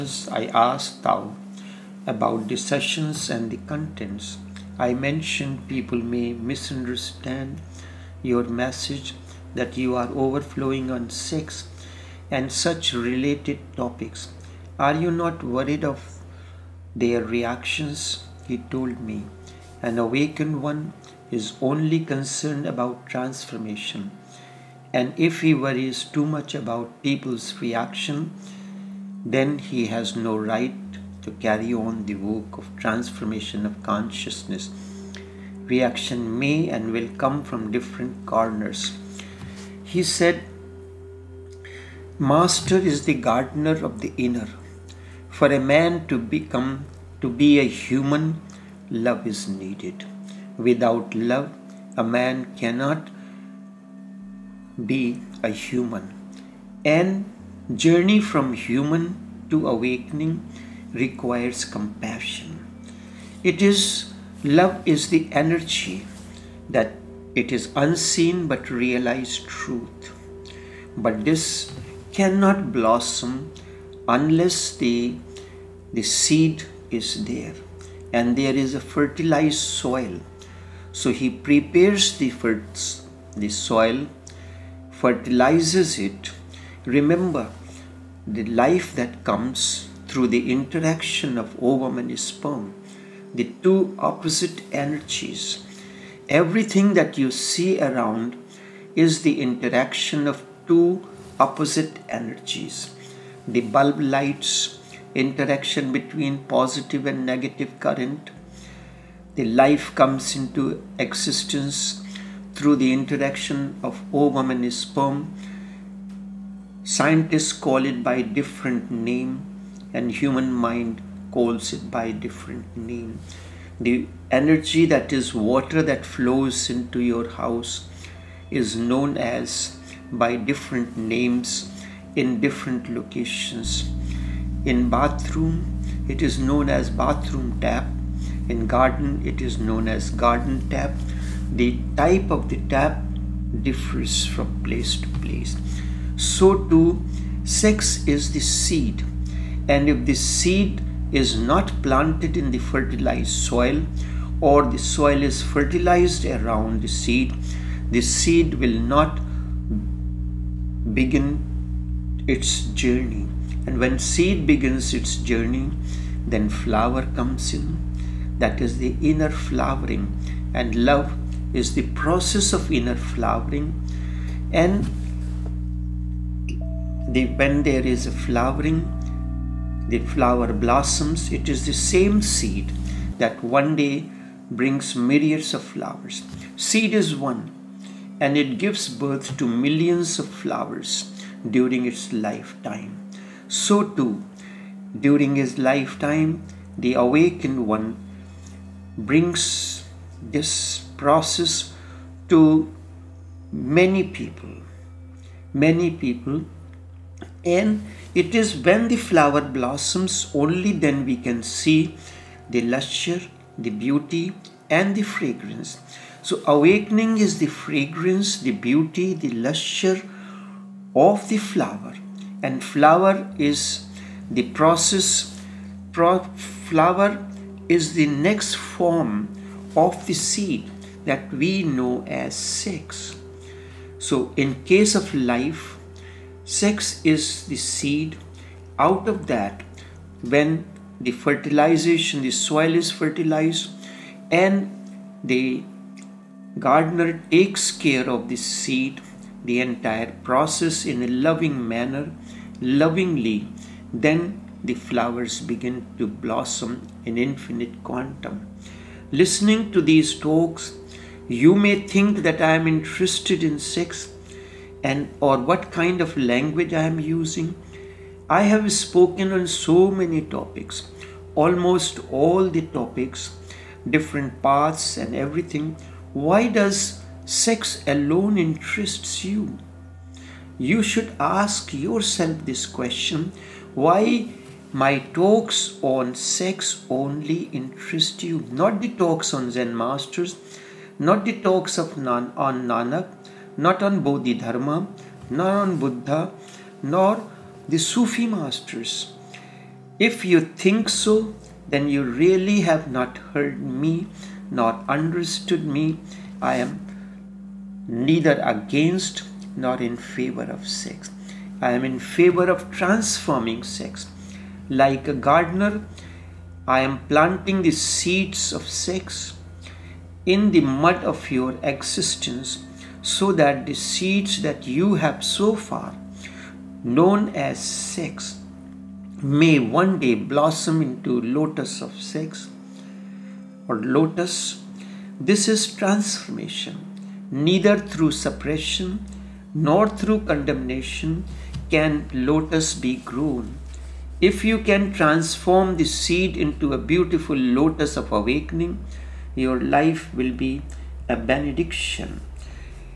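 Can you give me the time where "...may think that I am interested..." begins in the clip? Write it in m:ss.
4:21.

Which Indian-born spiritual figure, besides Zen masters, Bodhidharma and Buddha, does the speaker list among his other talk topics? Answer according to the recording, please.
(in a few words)
Nanak.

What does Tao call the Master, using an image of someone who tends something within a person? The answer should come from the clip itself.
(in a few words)
Gardener of the inner.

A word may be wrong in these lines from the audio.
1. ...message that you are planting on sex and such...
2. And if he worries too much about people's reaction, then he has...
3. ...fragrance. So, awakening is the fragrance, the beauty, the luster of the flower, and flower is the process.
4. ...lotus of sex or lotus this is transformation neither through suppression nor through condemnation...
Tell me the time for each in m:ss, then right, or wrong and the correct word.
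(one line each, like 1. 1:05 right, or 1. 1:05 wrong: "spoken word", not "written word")
1. 0:08 wrong: "overflowing", not "planting"
2. 0:24 right
3. 3:35 right
4. 5:31 right.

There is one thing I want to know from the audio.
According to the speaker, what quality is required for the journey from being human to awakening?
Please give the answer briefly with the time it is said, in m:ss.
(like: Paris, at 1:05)
Compassion, at 1:01.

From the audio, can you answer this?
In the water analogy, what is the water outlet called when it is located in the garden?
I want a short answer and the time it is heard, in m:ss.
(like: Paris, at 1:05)
Garden tap, at 2:20.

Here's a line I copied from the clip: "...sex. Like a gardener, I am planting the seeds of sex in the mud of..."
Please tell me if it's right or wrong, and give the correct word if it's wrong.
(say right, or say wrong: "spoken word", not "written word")
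right.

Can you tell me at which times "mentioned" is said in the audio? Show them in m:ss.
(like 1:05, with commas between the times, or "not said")
0:04.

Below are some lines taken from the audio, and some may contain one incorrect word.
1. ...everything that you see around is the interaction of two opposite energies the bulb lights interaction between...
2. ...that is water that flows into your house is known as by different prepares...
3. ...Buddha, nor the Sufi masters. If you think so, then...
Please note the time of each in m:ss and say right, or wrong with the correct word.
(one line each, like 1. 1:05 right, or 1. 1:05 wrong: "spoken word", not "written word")
1. 1:36 right
2. 2:04 wrong: "names", not "prepares"
3. 4:55 right.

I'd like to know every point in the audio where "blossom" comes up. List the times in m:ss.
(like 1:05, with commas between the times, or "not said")
1:12, 3:00, 3:29, 4:16, 5:30.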